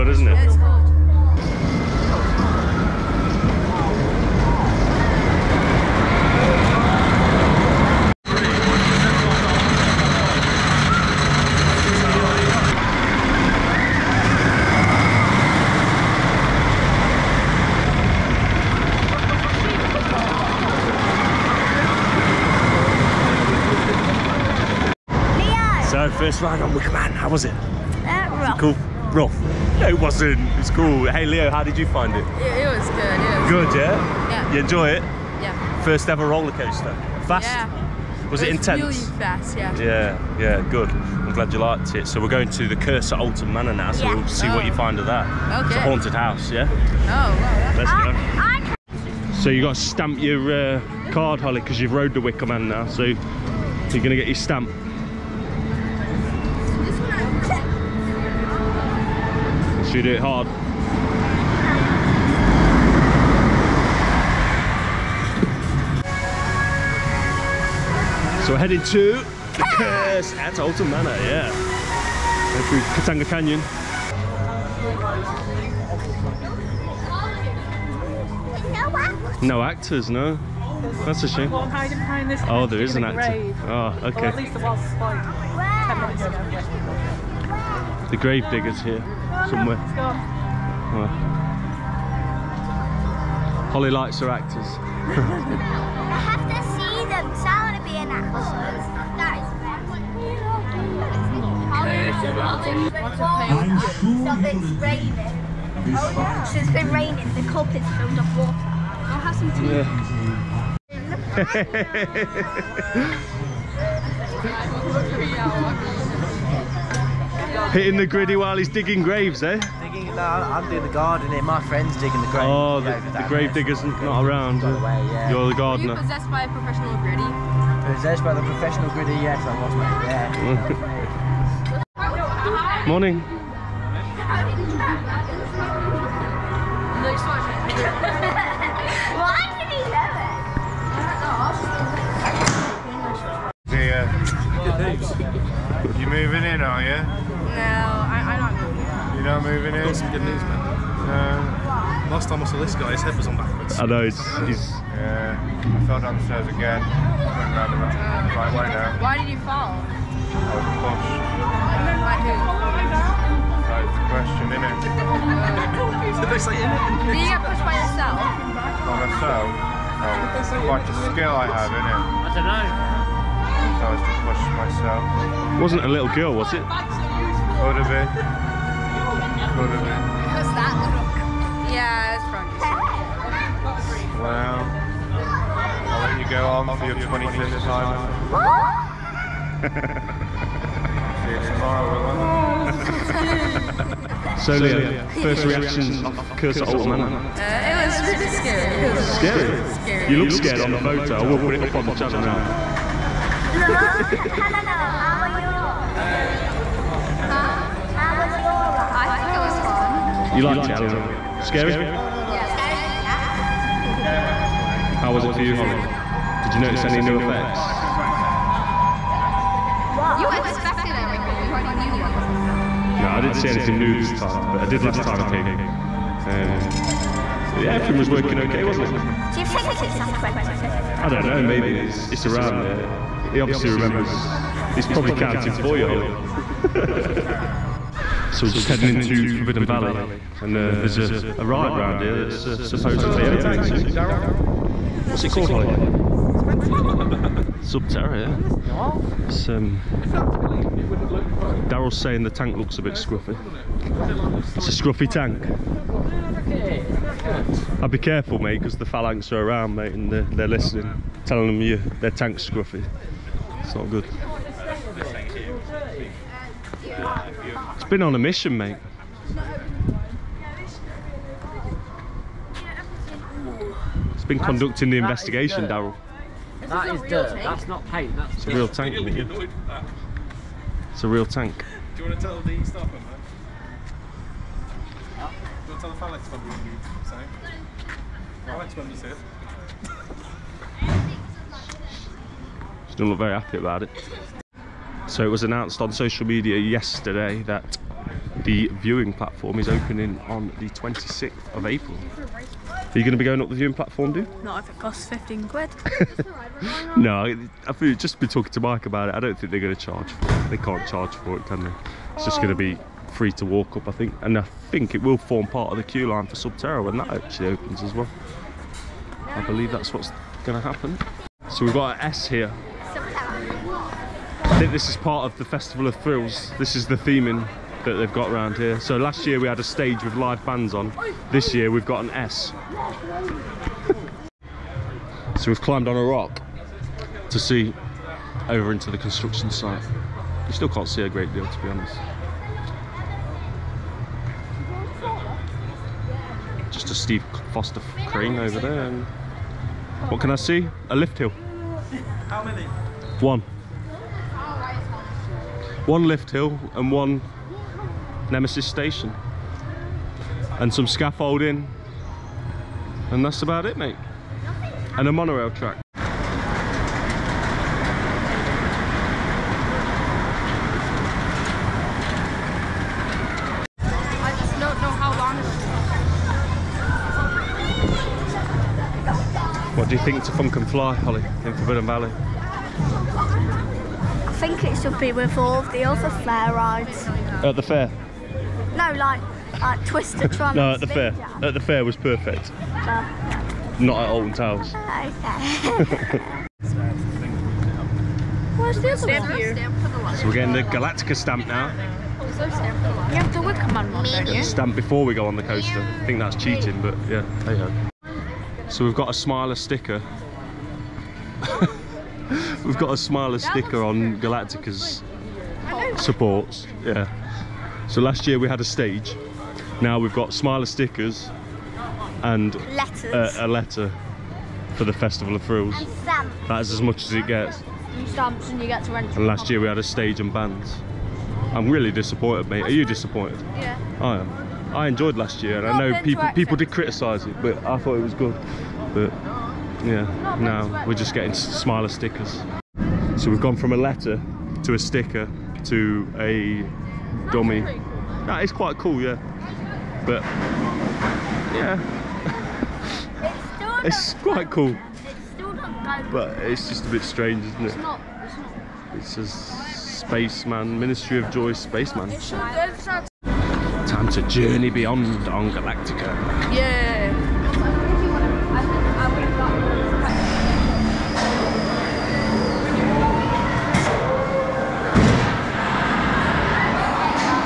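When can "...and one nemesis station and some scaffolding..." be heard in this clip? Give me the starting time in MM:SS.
05:56.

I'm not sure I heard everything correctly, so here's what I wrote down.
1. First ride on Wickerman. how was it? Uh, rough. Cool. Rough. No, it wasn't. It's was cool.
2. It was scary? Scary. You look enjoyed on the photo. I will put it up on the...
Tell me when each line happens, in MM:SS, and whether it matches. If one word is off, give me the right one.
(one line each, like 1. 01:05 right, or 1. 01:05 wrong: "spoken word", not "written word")
1. 00:26 right
2. 03:18 wrong: "scared", not "enjoyed".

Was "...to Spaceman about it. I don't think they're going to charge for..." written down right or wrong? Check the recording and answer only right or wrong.
wrong.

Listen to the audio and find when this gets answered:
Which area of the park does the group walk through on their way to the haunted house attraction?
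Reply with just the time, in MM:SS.
01:13.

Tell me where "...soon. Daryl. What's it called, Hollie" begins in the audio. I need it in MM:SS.
04:03.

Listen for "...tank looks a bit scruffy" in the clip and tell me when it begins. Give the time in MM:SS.
04:12.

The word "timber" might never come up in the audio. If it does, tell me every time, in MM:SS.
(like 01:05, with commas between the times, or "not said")
not said.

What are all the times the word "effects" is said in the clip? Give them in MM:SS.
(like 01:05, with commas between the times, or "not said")
03:37.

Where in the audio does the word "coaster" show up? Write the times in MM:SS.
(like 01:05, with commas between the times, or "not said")
00:36, 06:45.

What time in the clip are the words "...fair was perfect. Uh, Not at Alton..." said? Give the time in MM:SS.
06:31.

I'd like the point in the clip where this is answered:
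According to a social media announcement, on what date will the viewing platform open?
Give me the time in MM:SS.
05:00.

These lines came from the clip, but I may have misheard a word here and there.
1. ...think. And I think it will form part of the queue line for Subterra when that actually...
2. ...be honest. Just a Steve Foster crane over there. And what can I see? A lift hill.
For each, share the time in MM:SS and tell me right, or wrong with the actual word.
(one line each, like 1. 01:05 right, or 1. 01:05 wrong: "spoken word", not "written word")
1. 05:13 right
2. 05:41 right.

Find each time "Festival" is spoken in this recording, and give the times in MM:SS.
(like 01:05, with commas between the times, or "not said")
05:25, 07:04.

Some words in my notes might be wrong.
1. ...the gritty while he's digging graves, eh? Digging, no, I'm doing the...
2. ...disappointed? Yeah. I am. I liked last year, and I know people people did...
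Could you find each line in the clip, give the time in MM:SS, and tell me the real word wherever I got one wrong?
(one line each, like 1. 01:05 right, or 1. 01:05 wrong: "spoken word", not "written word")
1. 01:57 right
2. 07:12 wrong: "enjoyed", not "liked".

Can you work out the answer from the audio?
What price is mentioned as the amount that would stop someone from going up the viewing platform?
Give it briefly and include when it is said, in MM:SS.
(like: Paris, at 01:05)
15 quid, at 05:05.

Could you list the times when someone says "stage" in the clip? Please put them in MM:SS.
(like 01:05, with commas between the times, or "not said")
05:29, 06:58, 07:09.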